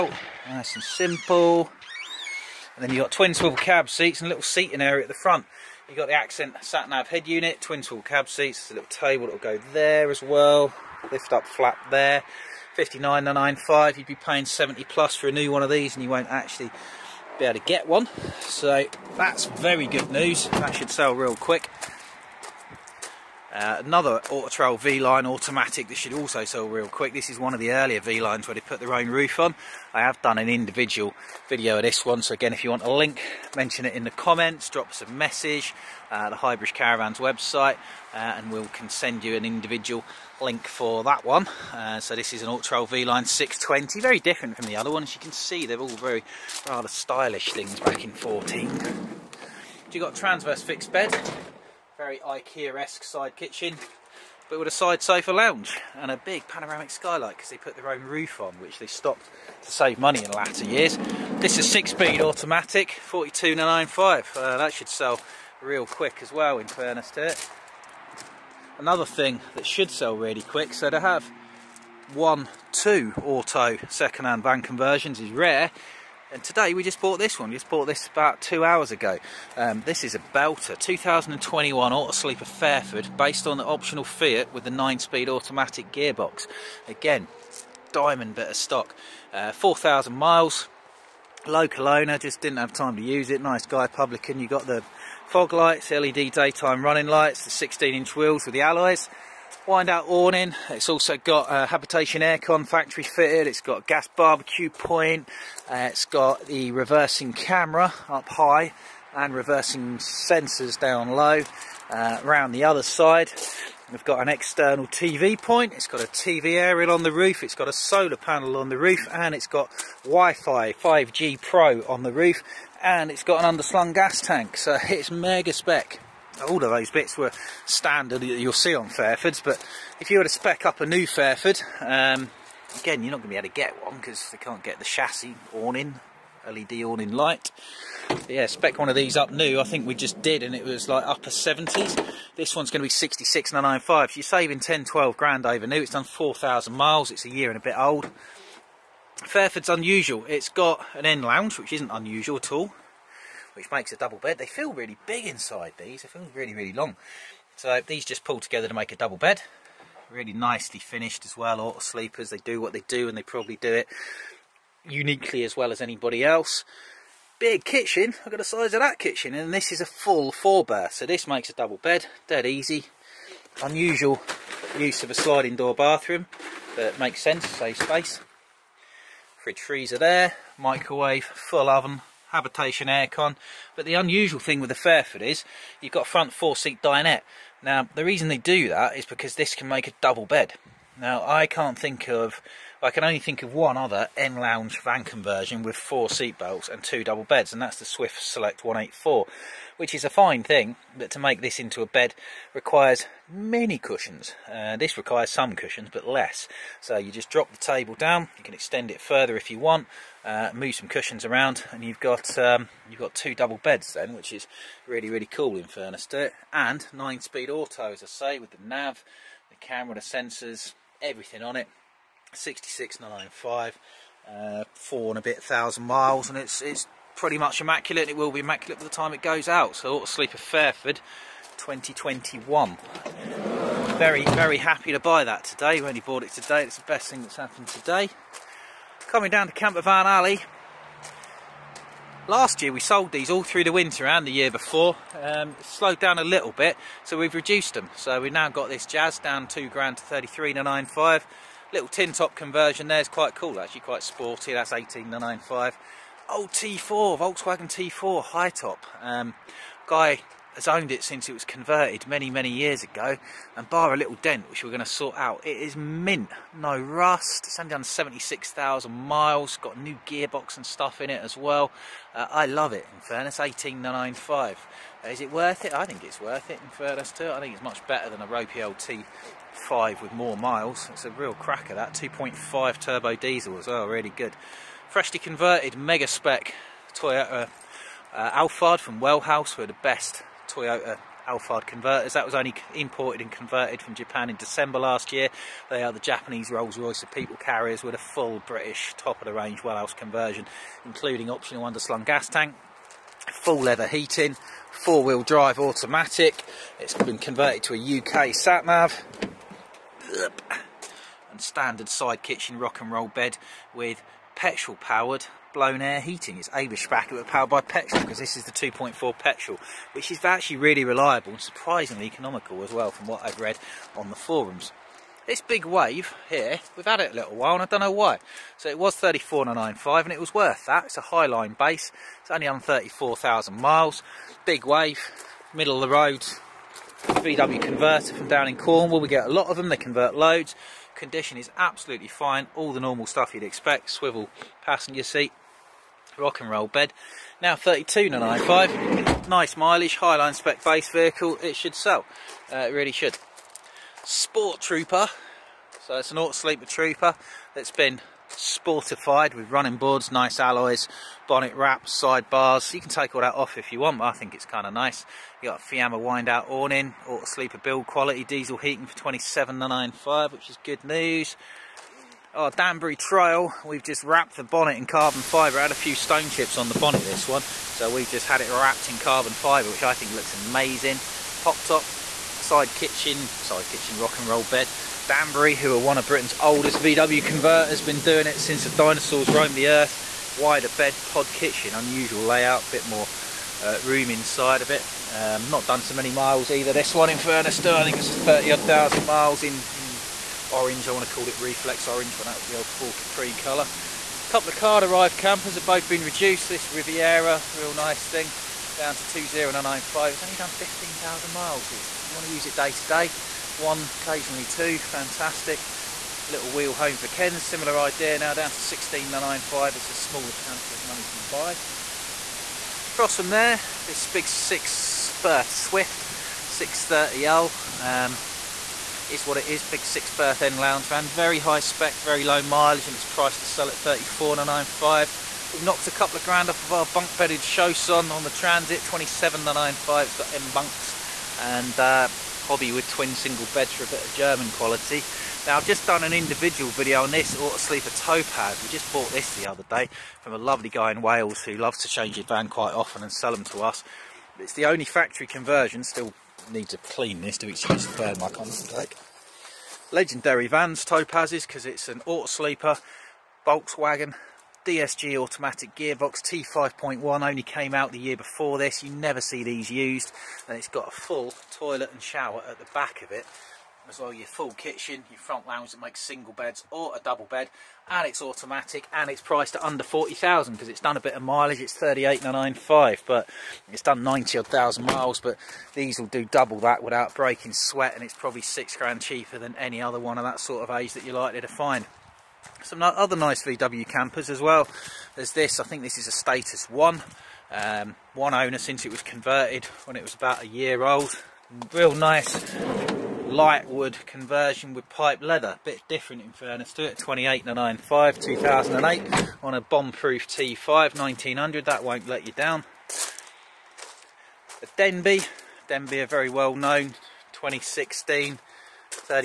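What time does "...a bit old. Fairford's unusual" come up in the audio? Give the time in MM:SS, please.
02:27.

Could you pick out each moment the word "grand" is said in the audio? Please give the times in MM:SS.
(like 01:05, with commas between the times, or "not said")
02:25, 04:09, 07:16, 08:08.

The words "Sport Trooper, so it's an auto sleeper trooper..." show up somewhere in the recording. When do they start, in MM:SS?
05:54.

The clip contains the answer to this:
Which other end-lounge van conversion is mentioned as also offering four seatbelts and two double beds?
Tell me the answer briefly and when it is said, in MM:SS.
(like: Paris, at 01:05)
Swift Select 184, at 03:17.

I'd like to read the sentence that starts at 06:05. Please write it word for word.
You got a Fiamma wind out awning, auto sleeper build quality, diesel heating for 27.95, which is good news.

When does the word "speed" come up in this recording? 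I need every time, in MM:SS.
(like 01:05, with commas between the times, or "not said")
01:01, 01:24, 03:36.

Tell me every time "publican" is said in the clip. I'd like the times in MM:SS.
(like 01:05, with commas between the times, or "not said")
01:33.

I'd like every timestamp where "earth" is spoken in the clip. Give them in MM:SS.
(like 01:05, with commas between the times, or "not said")
06:29.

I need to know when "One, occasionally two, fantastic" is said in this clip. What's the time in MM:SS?
06:53.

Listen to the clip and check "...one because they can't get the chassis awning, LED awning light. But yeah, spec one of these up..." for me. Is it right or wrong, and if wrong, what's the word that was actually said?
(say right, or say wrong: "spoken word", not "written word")
right.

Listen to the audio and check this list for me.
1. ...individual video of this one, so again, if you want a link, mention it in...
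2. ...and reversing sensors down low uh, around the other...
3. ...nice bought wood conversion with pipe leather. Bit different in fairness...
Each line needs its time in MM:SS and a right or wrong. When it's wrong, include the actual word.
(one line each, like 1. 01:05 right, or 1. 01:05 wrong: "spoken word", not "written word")
1. 00:30 right
2. 01:49 right
3. 08:21 wrong: "light", not "bought".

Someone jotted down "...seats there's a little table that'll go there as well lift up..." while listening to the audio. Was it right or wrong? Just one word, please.
right.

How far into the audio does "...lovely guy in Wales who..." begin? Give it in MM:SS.
07:30.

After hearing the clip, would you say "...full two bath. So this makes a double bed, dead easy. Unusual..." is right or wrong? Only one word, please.
wrong.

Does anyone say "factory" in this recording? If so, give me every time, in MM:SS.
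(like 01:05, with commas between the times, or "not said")
01:42, 07:34.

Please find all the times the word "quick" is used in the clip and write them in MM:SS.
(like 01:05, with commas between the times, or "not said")
00:21, 00:26, 01:05, 01:10.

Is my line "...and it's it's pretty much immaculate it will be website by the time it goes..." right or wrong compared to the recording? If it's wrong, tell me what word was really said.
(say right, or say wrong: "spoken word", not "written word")
wrong: "immaculate", not "website".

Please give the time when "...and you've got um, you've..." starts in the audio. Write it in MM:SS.
03:31.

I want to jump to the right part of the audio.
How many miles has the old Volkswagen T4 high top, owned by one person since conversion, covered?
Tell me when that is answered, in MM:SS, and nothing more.
04:27.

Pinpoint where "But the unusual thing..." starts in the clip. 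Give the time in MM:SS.
03:03.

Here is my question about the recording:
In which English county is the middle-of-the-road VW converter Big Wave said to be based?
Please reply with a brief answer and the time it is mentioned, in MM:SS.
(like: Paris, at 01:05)
Cornwall, at 05:38.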